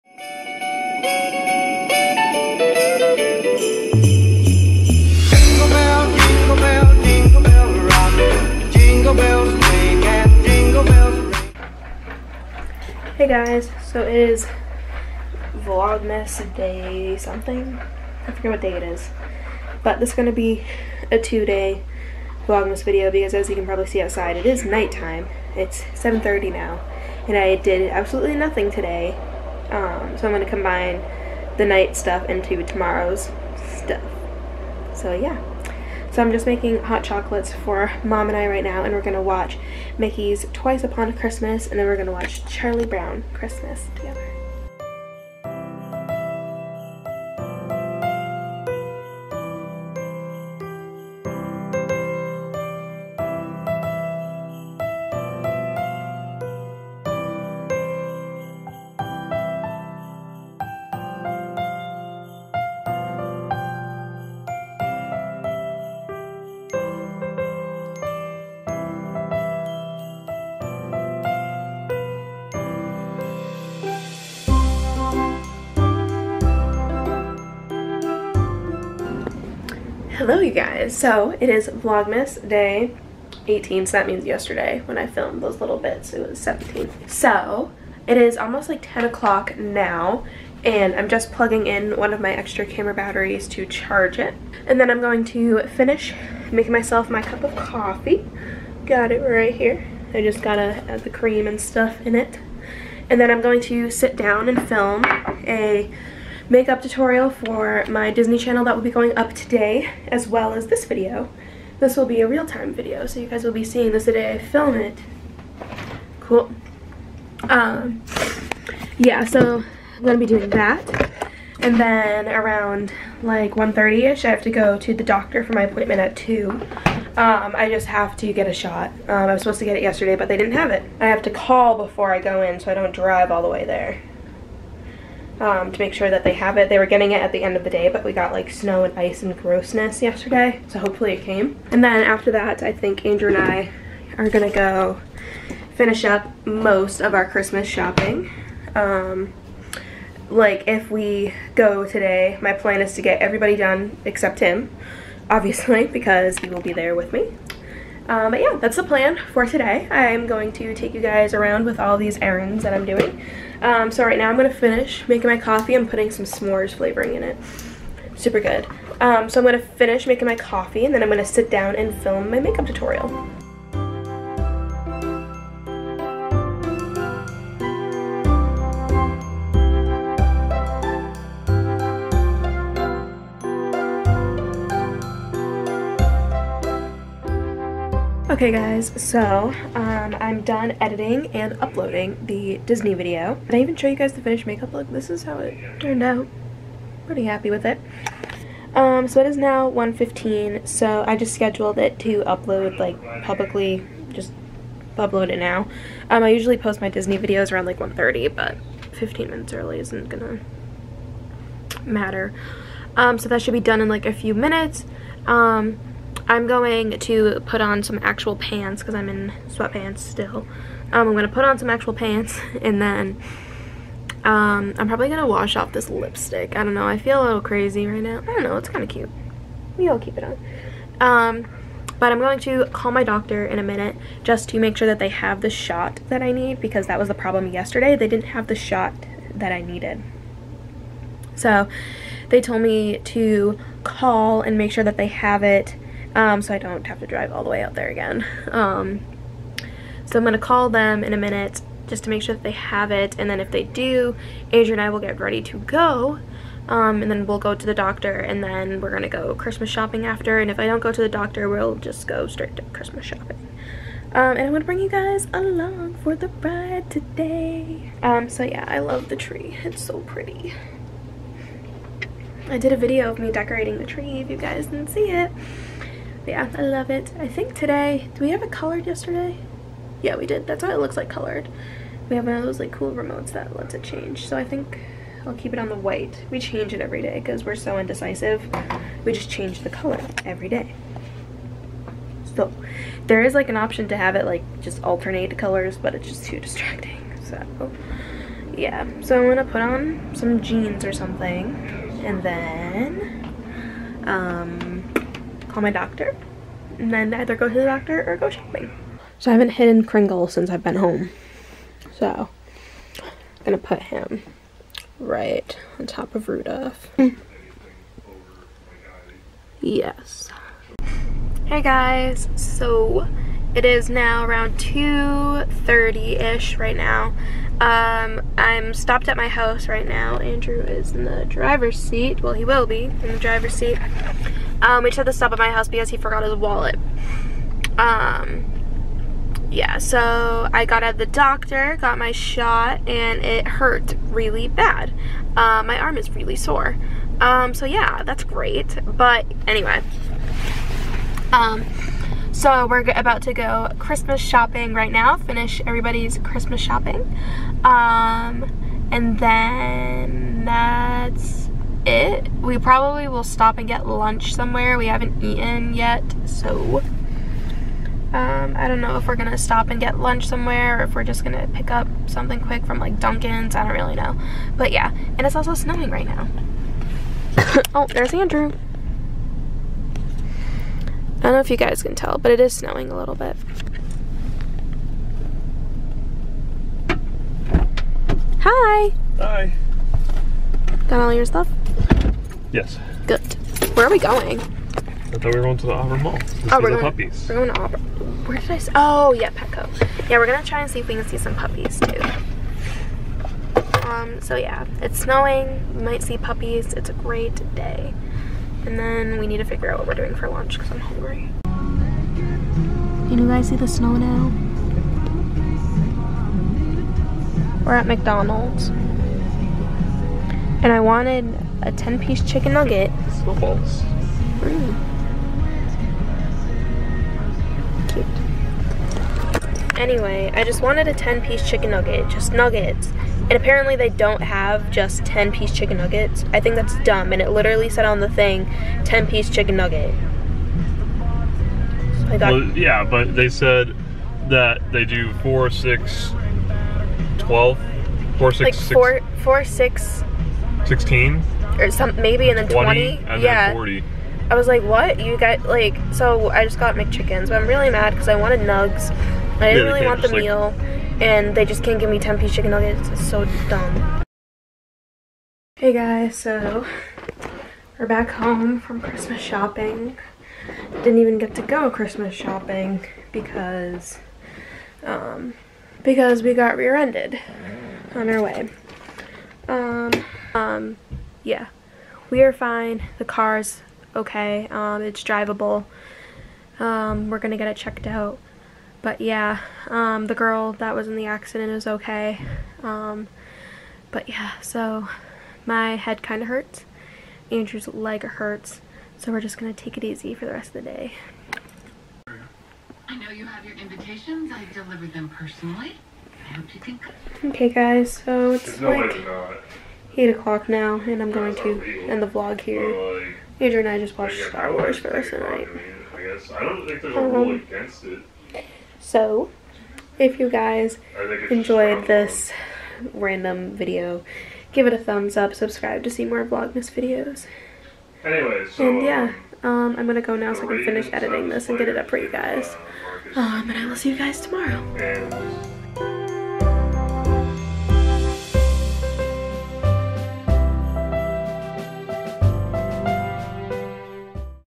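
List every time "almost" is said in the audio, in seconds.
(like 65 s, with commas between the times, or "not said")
88 s.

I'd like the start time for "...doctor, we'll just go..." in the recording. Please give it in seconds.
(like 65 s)
261 s.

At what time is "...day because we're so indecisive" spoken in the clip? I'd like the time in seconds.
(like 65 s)
287 s.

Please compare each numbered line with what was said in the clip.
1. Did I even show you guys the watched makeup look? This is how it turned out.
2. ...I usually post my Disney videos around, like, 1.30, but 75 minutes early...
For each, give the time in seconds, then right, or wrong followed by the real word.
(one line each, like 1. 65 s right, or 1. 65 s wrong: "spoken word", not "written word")
1. 193 s wrong: "finished", not "watched"
2. 206 s wrong: "15", not "75".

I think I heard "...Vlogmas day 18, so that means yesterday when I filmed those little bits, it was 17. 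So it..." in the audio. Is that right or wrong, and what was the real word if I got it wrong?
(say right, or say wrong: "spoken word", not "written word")
right.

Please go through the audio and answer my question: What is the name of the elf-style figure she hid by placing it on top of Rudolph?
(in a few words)
Kringle.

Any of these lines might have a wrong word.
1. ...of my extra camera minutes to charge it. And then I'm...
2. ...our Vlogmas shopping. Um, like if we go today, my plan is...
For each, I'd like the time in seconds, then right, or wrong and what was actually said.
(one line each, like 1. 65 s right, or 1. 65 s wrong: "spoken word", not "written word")
1. 92 s wrong: "batteries", not "minutes"
2. 147 s wrong: "Christmas", not "Vlogmas".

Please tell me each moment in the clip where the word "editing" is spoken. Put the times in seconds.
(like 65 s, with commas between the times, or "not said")
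190 s, 530 s.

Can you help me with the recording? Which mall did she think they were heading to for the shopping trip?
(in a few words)
Auburn Mall.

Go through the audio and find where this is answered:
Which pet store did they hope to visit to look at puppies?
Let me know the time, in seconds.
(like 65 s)
399 s.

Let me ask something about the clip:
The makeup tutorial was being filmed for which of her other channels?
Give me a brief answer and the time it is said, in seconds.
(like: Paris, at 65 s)
Disney channel, at 108 s.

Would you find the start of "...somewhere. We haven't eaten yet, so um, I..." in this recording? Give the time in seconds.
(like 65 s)
364 s.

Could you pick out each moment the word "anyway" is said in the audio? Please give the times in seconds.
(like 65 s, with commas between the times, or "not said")
349 s, 429 s, 528 s.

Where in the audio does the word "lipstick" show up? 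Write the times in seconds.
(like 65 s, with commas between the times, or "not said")
225 s.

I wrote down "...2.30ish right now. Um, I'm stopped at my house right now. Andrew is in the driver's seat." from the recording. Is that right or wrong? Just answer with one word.
right.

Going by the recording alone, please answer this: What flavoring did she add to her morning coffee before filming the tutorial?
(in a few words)
S'mores.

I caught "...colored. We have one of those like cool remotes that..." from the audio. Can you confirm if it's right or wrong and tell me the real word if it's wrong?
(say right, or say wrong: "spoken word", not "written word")
right.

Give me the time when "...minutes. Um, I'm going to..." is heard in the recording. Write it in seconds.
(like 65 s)
214 s.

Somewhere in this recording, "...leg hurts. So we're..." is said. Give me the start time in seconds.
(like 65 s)
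497 s.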